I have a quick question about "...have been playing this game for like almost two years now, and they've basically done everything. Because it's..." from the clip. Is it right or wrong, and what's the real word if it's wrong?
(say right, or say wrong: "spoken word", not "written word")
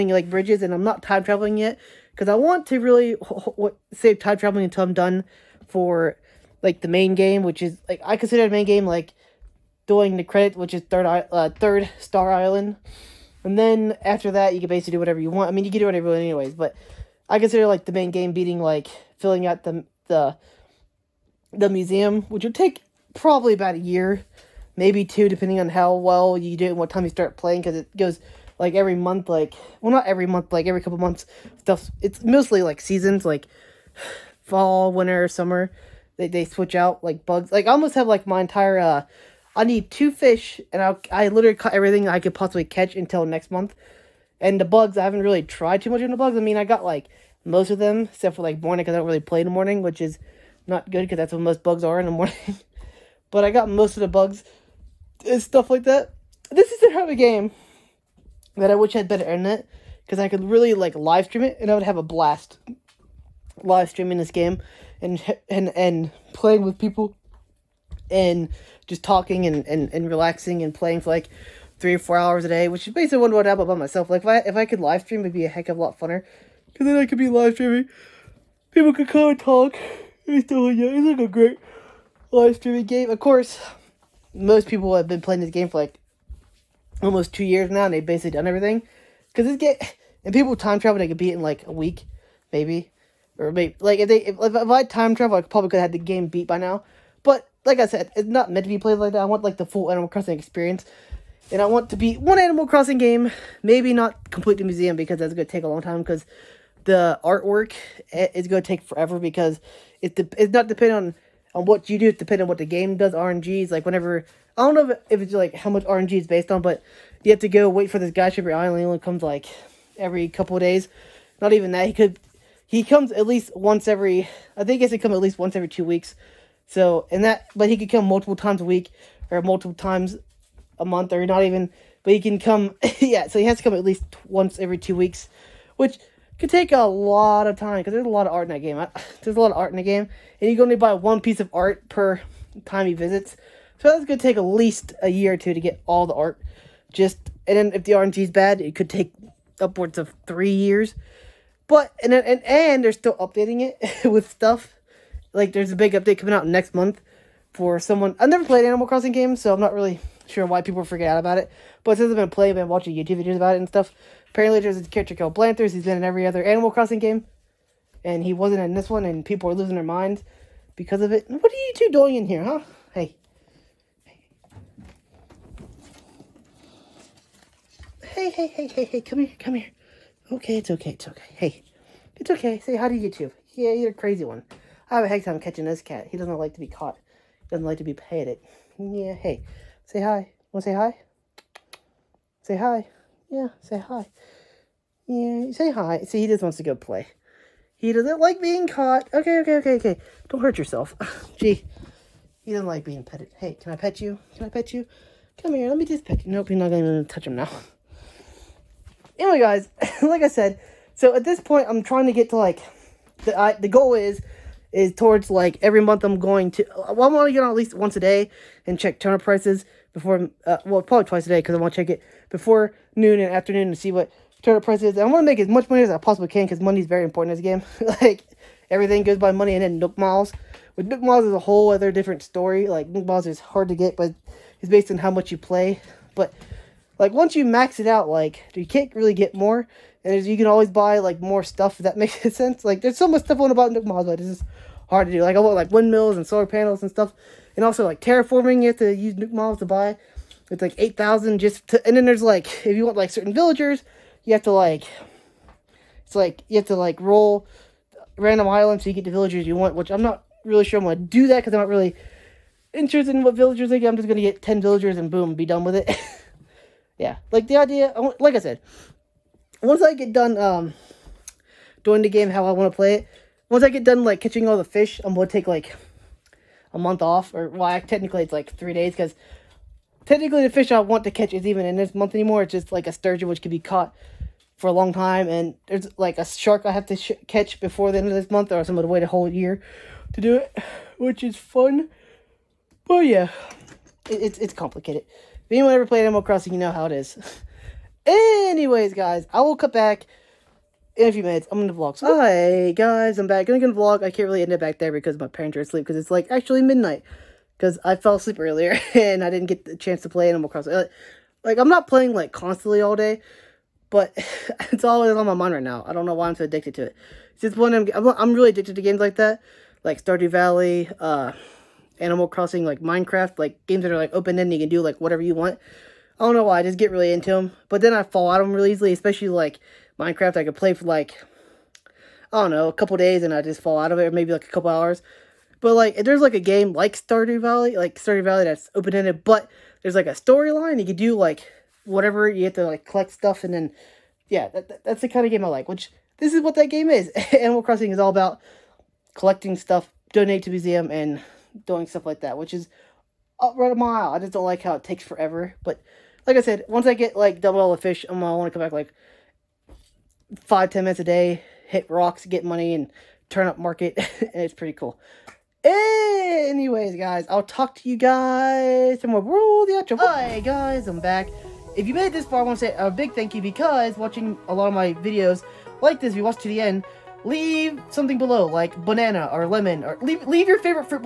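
right.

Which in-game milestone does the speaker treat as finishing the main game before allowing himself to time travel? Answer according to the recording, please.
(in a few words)
third Star Island.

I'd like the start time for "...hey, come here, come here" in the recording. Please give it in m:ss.
2:58.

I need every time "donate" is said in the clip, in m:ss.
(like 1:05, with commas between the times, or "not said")
5:50.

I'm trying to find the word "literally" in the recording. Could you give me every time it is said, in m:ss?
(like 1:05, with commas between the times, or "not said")
0:41.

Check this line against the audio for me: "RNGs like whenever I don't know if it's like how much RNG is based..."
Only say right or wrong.
right.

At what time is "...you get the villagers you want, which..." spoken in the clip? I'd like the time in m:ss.
4:18.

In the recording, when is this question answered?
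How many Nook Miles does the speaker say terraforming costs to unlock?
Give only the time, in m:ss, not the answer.
4:10.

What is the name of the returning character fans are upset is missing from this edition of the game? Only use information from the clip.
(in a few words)
Blanthers.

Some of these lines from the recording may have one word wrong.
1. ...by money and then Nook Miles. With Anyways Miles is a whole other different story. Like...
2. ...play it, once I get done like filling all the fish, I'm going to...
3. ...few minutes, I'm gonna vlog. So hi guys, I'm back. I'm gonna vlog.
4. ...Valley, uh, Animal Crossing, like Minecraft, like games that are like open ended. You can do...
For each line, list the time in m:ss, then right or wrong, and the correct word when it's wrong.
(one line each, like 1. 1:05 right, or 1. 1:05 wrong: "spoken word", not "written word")
1. 3:49 wrong: "Nook", not "Anyways"
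2. 4:32 wrong: "catching", not "filling"
3. 5:01 right
4. 5:20 right.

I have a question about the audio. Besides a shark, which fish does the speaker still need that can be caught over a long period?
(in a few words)
sturgeon.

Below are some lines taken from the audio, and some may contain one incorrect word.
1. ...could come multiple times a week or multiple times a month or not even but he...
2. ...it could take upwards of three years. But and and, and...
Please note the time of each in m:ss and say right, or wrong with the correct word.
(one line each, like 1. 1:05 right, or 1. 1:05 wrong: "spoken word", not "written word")
1. 2:07 right
2. 2:28 right.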